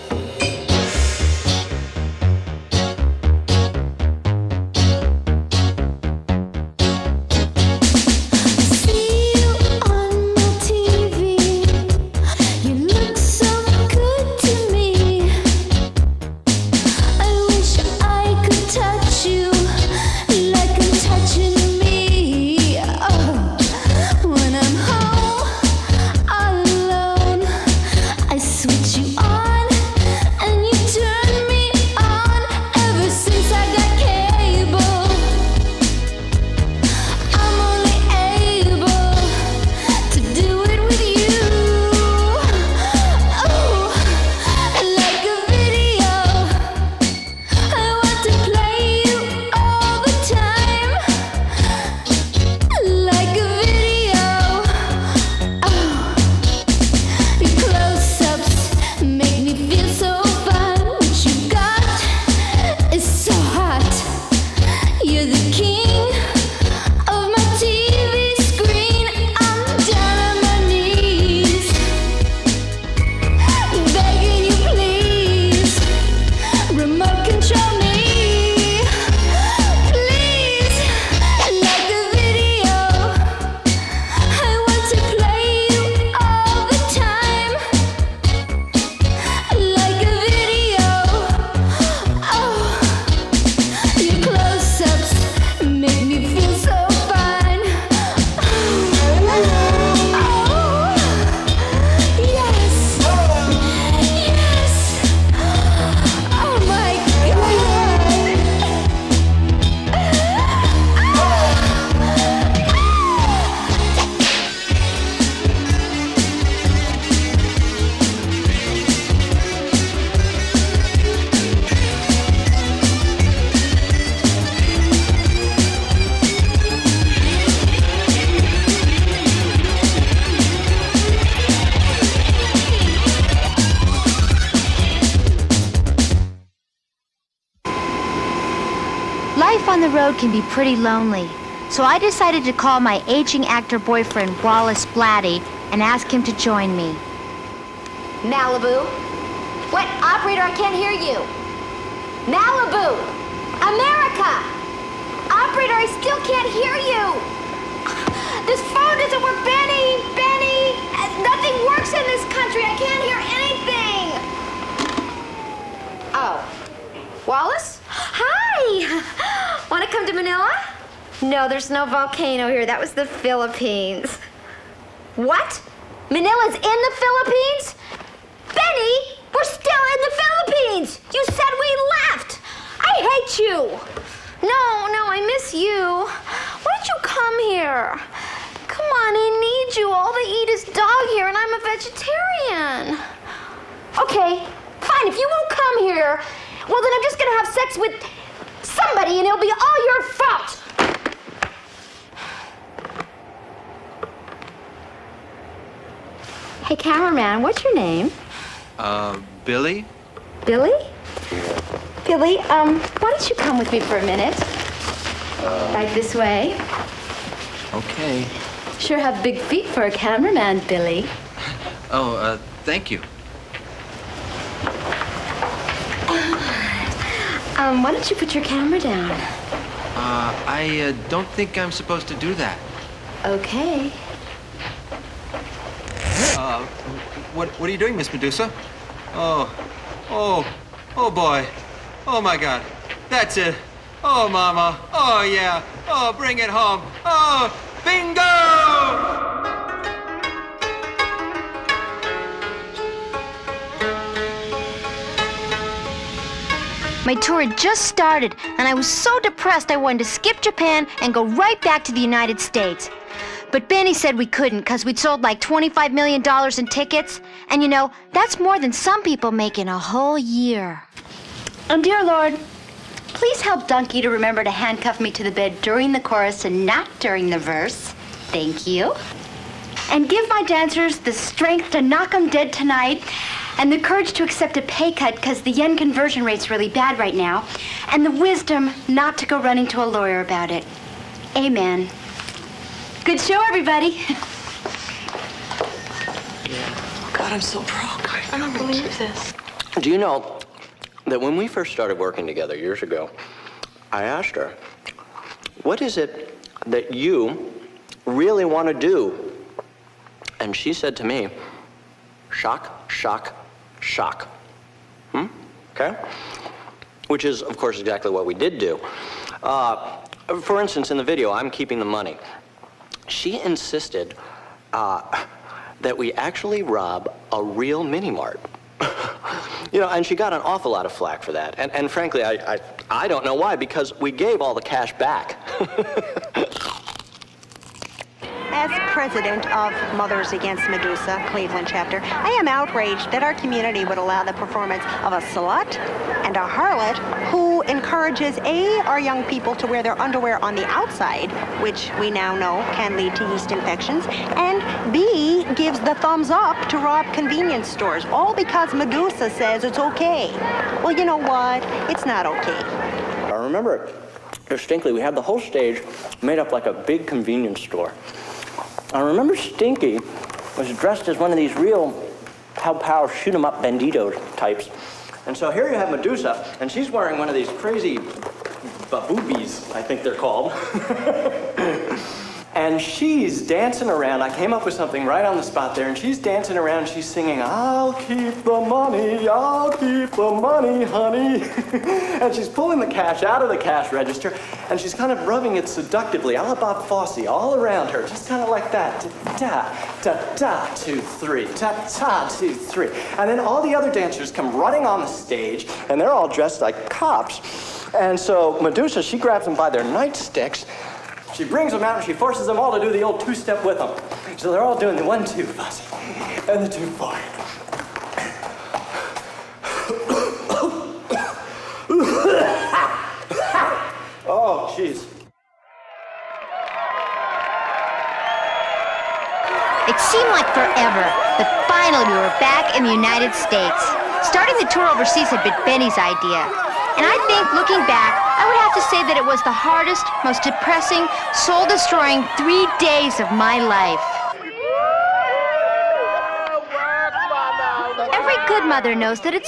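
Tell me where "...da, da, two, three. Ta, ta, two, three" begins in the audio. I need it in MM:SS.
06:40.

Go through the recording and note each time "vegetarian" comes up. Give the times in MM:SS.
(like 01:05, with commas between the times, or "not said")
03:11.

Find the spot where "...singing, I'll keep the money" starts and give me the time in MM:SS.
06:27.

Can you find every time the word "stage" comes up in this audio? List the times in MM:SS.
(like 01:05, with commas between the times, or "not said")
06:05, 06:45.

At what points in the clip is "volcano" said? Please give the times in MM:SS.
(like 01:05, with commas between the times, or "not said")
02:51.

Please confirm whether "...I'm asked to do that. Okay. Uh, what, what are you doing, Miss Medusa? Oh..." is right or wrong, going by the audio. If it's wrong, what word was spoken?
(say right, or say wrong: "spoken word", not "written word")
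wrong: "supposed", not "asked".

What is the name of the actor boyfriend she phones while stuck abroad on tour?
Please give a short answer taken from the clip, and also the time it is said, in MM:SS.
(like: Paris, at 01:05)
Wallace Blatty, at 02:24.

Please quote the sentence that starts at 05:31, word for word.
And, and frankly, I, I, I don't know why, because we gave all the cash back.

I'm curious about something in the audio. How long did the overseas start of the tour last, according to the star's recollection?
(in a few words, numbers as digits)
3 days.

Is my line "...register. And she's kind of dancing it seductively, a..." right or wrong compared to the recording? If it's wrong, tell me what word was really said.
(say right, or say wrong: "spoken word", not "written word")
wrong: "rubbing", not "dancing".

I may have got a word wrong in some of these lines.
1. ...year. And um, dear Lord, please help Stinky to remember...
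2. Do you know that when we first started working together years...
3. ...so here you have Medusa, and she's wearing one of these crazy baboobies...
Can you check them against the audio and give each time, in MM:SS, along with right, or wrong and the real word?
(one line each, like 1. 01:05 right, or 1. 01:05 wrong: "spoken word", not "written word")
1. 04:30 wrong: "Donkey", not "Stinky"
2. 04:59 right
3. 06:15 right.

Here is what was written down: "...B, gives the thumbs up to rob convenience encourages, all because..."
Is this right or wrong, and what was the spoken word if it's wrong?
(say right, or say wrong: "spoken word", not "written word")
wrong: "stores", not "encourages".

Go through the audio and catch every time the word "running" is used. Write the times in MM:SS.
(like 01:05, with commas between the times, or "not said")
04:49, 06:44.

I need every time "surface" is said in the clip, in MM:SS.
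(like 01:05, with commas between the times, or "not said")
not said.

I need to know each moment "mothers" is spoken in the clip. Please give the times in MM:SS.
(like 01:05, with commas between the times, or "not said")
05:39, 07:28.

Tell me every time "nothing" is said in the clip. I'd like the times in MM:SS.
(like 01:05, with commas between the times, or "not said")
02:41.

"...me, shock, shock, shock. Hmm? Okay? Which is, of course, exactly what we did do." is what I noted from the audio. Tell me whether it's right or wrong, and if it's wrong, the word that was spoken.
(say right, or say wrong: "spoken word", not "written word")
right.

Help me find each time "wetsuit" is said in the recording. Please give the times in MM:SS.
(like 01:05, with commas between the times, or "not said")
not said.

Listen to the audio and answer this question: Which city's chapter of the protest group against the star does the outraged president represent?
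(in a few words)
Cleveland.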